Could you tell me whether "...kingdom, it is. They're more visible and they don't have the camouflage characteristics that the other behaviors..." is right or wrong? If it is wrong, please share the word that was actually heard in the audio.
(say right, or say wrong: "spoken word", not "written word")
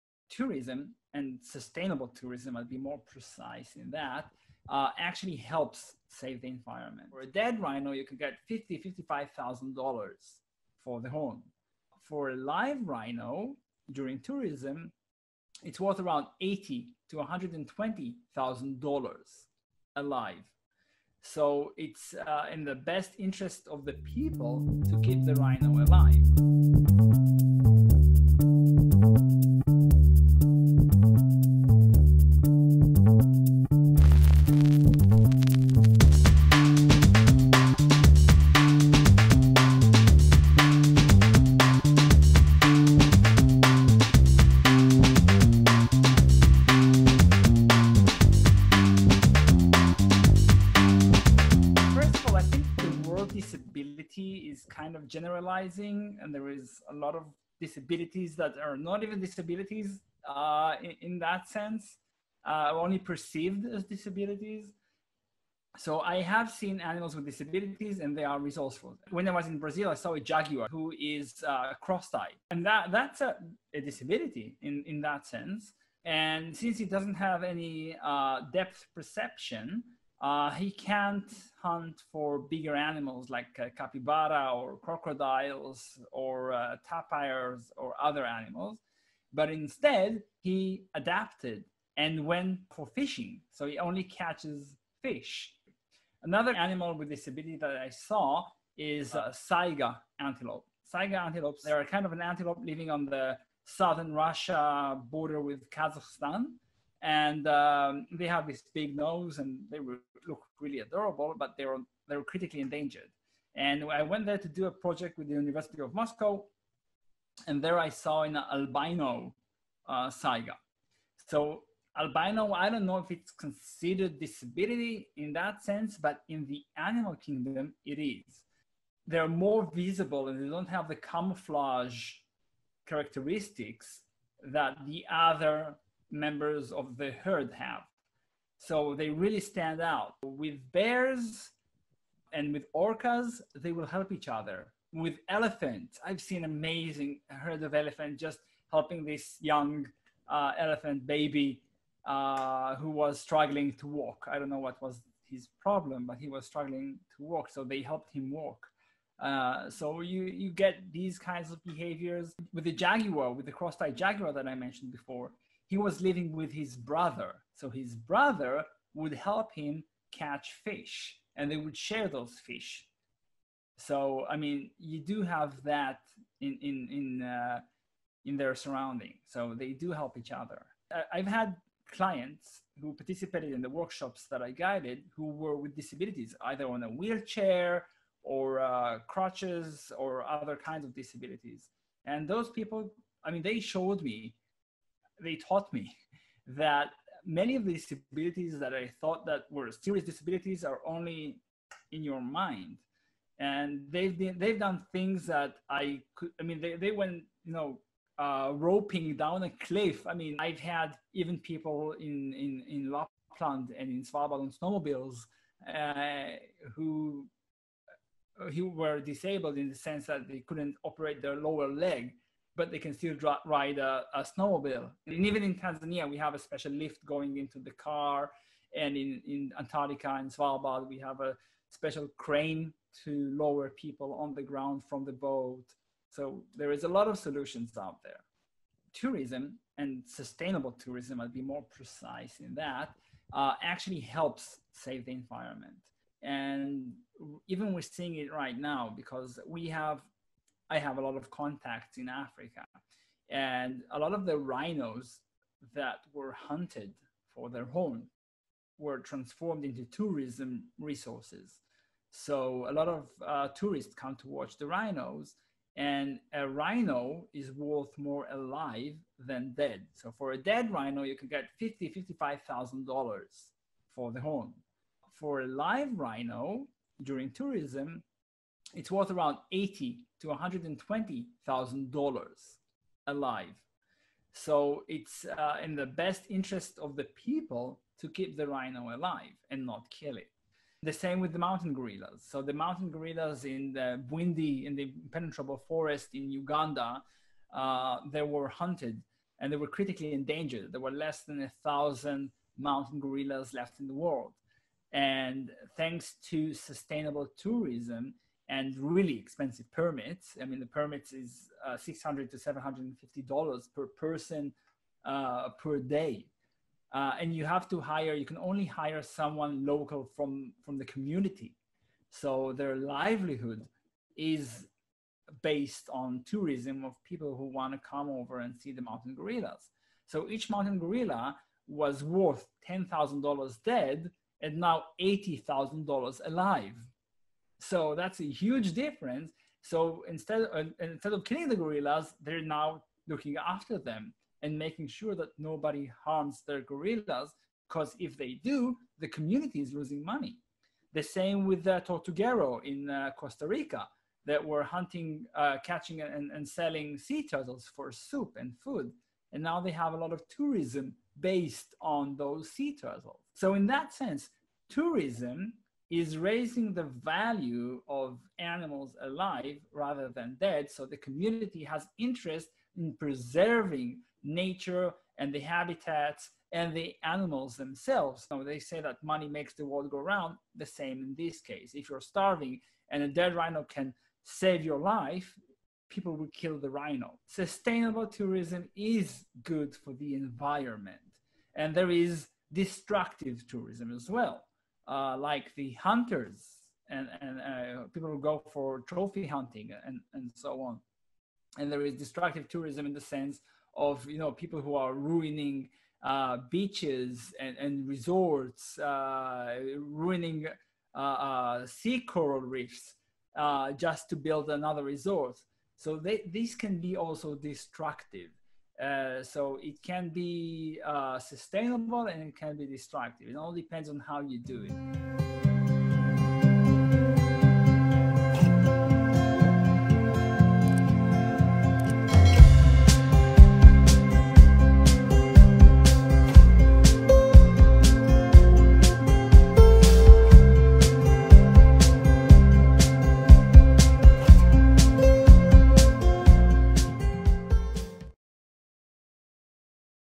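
wrong: "members", not "behaviors".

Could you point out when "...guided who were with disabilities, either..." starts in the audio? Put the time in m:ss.
3:04.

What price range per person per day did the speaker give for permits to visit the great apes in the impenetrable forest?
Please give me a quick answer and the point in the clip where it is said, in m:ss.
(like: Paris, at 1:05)
$600 to $750, at 5:11.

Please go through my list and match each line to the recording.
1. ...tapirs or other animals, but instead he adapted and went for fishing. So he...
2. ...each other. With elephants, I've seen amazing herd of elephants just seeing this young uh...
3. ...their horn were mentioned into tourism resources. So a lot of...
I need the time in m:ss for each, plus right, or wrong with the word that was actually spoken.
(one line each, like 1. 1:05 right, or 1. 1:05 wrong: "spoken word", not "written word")
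1. 1:26 right
2. 2:24 wrong: "helping", not "seeing"
3. 4:17 wrong: "transformed", not "mentioned".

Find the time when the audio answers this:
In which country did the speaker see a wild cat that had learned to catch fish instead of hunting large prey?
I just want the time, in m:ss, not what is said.
1:09.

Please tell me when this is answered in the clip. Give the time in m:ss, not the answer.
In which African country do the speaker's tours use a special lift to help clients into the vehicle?
3:45.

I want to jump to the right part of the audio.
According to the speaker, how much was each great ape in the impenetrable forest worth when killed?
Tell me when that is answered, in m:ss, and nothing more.
5:32.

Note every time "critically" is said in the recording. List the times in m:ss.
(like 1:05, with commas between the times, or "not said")
1:52, 4:59.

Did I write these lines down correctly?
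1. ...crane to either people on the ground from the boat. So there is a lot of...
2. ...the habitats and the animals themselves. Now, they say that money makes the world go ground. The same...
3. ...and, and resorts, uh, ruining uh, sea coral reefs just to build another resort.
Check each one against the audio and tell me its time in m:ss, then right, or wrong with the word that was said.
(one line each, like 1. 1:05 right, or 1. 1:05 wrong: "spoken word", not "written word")
1. 3:52 wrong: "lower", not "either"
2. 6:15 wrong: "round", not "ground"
3. 6:47 right.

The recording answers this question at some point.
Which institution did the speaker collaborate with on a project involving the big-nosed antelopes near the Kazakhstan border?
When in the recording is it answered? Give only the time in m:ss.
1:55.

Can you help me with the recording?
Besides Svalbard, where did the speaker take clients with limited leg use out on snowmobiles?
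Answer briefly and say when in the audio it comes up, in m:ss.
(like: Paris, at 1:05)
Lapland, at 3:32.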